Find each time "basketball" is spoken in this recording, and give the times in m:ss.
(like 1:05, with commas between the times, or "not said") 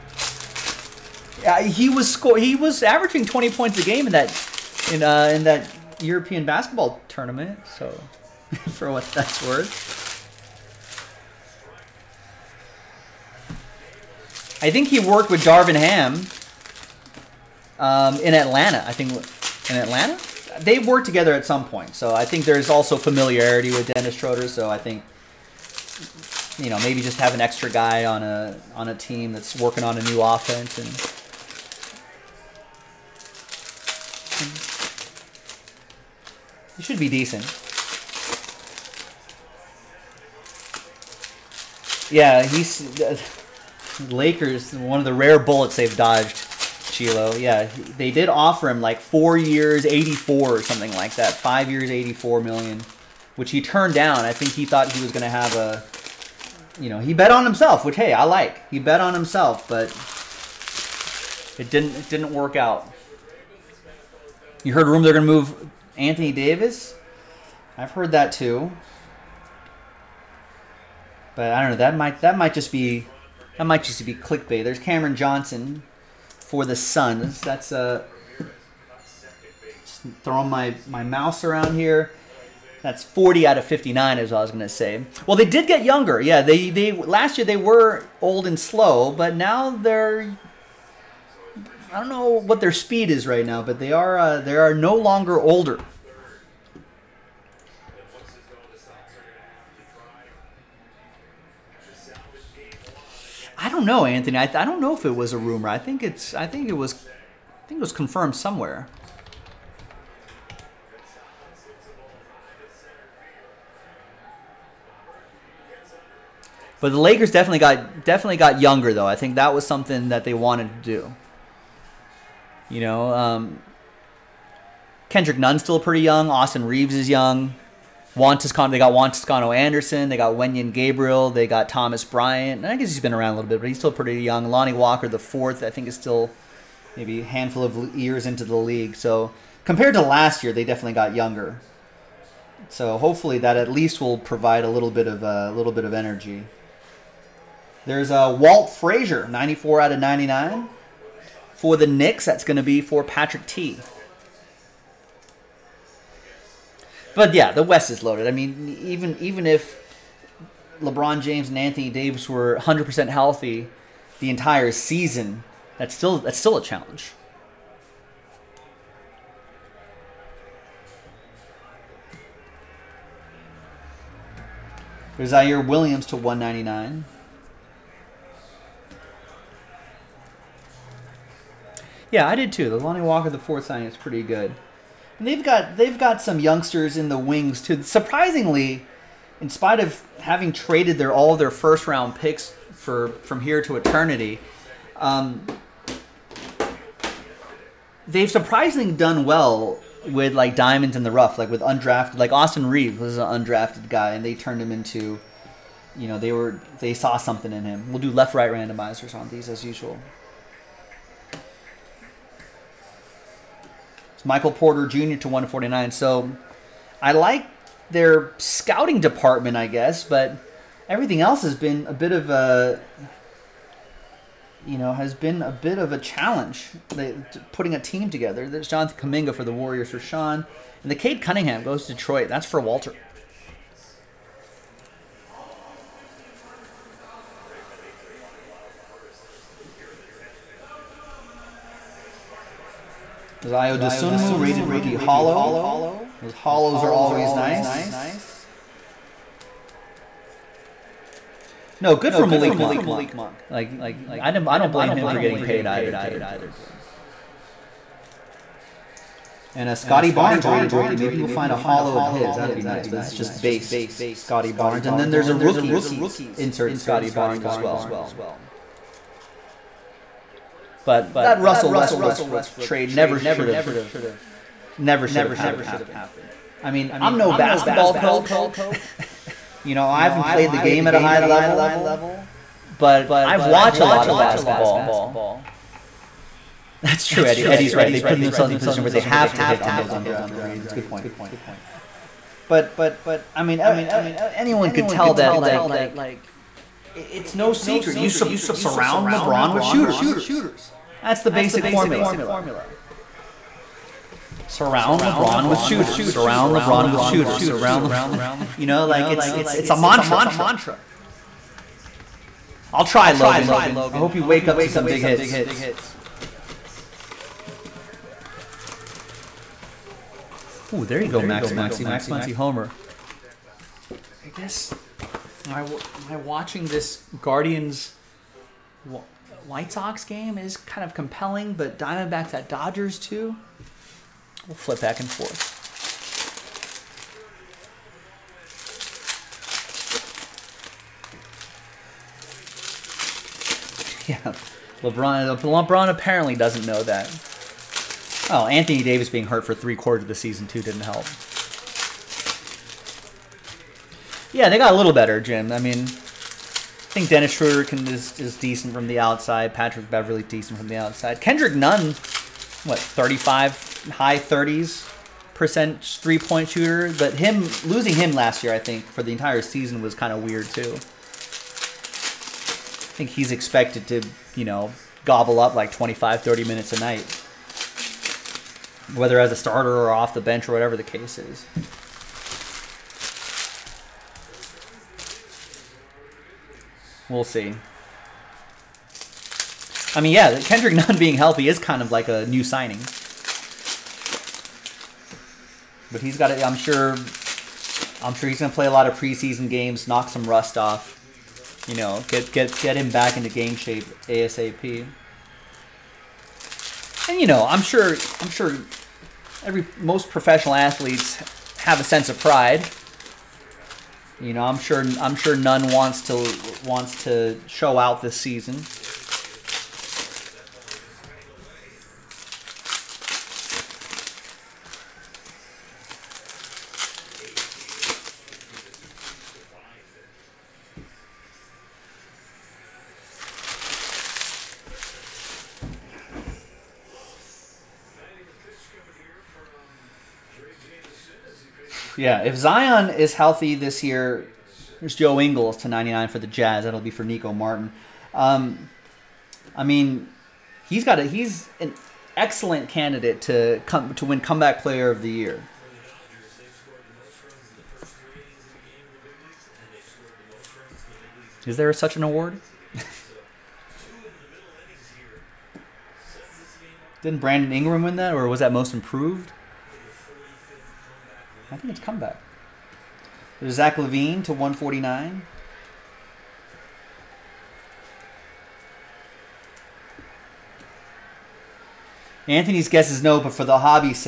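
0:06, 4:37, 4:44.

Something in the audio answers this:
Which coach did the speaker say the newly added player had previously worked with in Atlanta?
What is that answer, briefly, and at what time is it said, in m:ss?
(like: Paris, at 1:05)
Darvin Ham, at 0:15.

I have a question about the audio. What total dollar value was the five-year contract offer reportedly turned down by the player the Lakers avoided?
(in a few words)
84 million.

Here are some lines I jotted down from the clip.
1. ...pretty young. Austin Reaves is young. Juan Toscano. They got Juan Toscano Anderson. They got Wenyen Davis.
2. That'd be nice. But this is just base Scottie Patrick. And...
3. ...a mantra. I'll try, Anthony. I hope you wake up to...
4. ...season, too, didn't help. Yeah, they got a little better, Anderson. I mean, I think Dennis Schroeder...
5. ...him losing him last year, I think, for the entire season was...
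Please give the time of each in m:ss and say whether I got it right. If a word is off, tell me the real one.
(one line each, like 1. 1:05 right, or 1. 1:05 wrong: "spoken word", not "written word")
1. 2:05 wrong: "Gabriel", not "Davis"
2. 4:22 wrong: "Barnes", not "Patrick"
3. 5:09 wrong: "Logan", not "Anthony"
4. 5:50 wrong: "Jim", not "Anderson"
5. 6:07 right.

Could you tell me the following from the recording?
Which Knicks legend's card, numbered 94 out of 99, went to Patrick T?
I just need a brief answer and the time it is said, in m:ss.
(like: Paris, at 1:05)
Walt Frazier, at 2:28.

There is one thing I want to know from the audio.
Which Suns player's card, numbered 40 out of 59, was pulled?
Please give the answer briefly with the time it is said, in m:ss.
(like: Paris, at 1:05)
Cameron Johnson, at 1:14.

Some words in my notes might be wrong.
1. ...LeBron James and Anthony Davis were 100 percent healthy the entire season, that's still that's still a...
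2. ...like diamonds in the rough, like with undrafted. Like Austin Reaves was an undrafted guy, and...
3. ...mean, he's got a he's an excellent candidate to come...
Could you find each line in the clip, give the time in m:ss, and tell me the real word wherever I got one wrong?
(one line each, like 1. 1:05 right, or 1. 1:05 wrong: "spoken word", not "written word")
1. 2:40 right
2. 3:20 right
3. 7:29 right.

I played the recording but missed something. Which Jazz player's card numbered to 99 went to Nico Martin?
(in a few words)
Joe Ingles.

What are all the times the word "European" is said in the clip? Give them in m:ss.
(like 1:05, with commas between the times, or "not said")
0:06.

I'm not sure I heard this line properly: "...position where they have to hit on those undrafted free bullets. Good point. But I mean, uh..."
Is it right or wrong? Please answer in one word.
wrong.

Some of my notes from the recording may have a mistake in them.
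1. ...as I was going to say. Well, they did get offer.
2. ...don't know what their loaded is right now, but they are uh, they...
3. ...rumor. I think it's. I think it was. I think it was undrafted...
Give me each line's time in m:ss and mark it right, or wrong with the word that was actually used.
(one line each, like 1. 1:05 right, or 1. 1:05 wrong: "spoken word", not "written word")
1. 1:24 wrong: "younger", not "offer"
2. 1:31 wrong: "speed", not "loaded"
3. 1:45 wrong: "confirmed", not "undrafted".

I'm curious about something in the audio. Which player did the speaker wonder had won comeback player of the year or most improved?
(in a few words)
Brandon Ingram.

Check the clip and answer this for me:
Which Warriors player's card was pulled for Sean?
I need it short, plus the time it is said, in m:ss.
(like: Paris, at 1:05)
Jonathan Kuminga, at 3:48.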